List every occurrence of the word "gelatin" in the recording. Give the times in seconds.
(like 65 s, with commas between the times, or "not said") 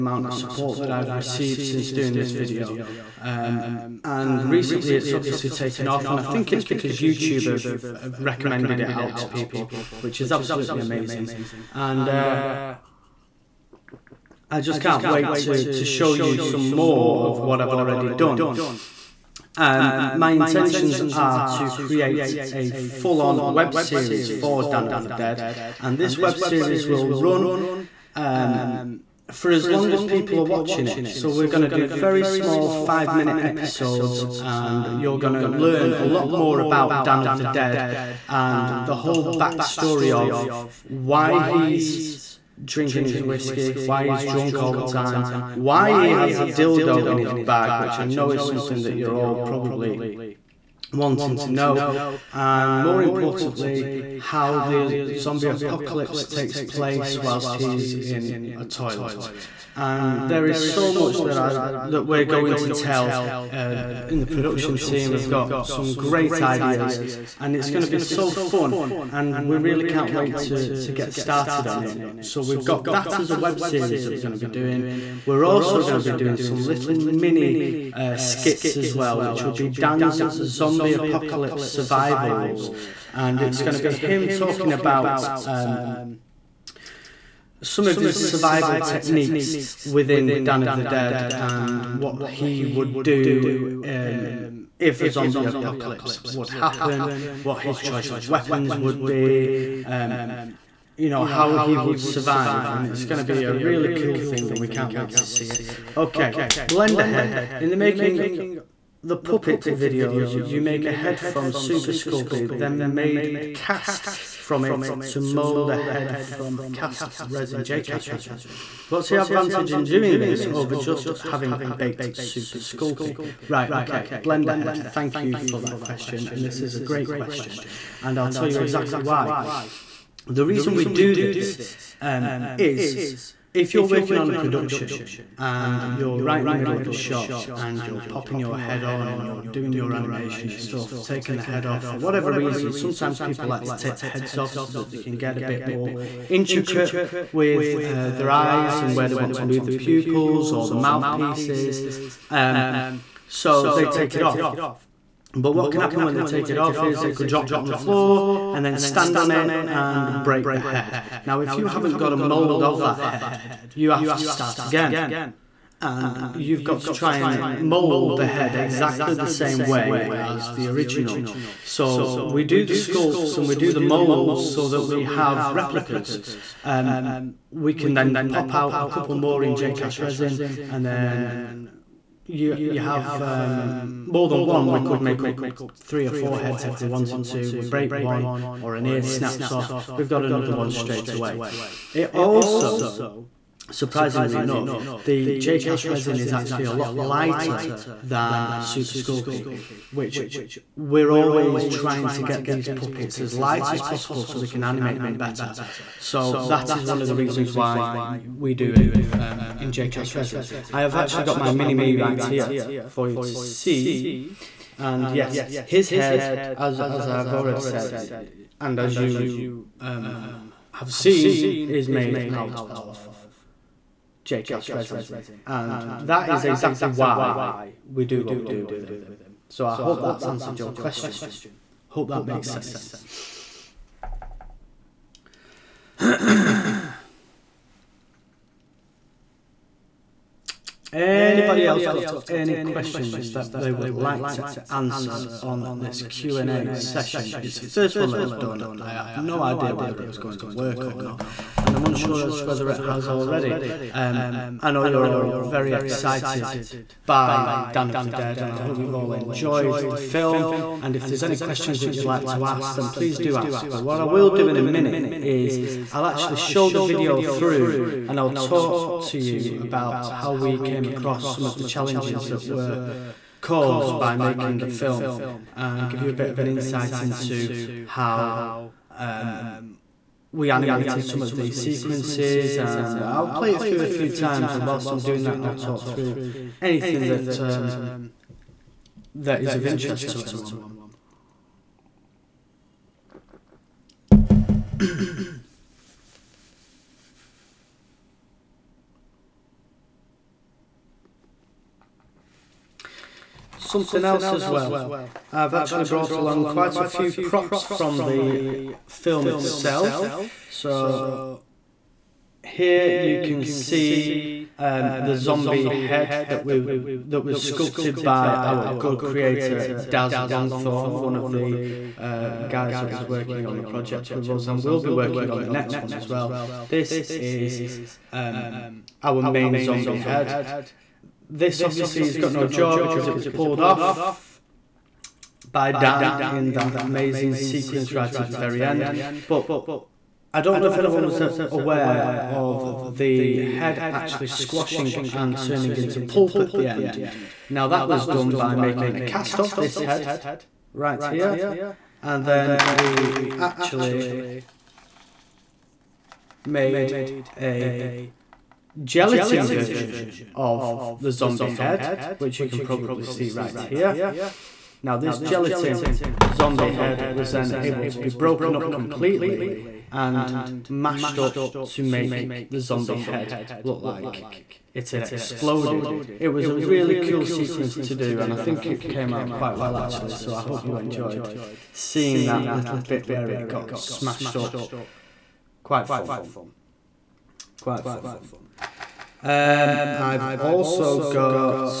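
358 s, 365 s.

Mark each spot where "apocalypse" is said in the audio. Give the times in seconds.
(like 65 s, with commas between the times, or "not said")
55 s, 80 s, 95 s.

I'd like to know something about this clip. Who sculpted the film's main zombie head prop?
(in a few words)
Daz Longthorne.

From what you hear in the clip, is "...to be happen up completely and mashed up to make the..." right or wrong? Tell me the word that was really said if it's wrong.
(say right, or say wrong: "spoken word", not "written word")
wrong: "broken", not "happen".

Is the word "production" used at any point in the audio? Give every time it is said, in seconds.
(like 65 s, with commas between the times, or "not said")
64 s, 134 s.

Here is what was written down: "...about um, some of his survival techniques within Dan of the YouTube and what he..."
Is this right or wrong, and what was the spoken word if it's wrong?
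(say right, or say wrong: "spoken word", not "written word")
wrong: "Dead", not "YouTube".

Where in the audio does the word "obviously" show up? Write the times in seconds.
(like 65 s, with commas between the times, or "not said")
5 s, 331 s.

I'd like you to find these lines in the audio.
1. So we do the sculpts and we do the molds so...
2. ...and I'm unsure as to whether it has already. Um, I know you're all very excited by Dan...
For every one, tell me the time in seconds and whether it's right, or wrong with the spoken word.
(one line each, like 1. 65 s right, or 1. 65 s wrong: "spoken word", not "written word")
1. 171 s right
2. 251 s right.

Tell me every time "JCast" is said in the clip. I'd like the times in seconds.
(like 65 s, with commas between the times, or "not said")
179 s, 209 s, 224 s.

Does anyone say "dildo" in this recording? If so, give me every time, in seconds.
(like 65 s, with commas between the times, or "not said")
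46 s.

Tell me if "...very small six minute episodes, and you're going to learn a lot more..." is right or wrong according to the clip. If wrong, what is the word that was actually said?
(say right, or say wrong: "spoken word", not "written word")
wrong: "five", not "six".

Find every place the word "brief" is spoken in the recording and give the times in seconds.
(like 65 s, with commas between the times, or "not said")
not said.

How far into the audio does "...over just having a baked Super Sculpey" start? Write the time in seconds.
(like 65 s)
120 s.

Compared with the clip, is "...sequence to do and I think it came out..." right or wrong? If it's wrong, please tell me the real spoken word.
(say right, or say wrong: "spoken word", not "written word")
right.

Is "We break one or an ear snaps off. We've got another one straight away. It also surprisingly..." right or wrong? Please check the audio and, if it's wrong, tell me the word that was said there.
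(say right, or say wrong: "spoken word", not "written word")
right.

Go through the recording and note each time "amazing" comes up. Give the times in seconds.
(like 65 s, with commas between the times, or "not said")
10 s, 336 s.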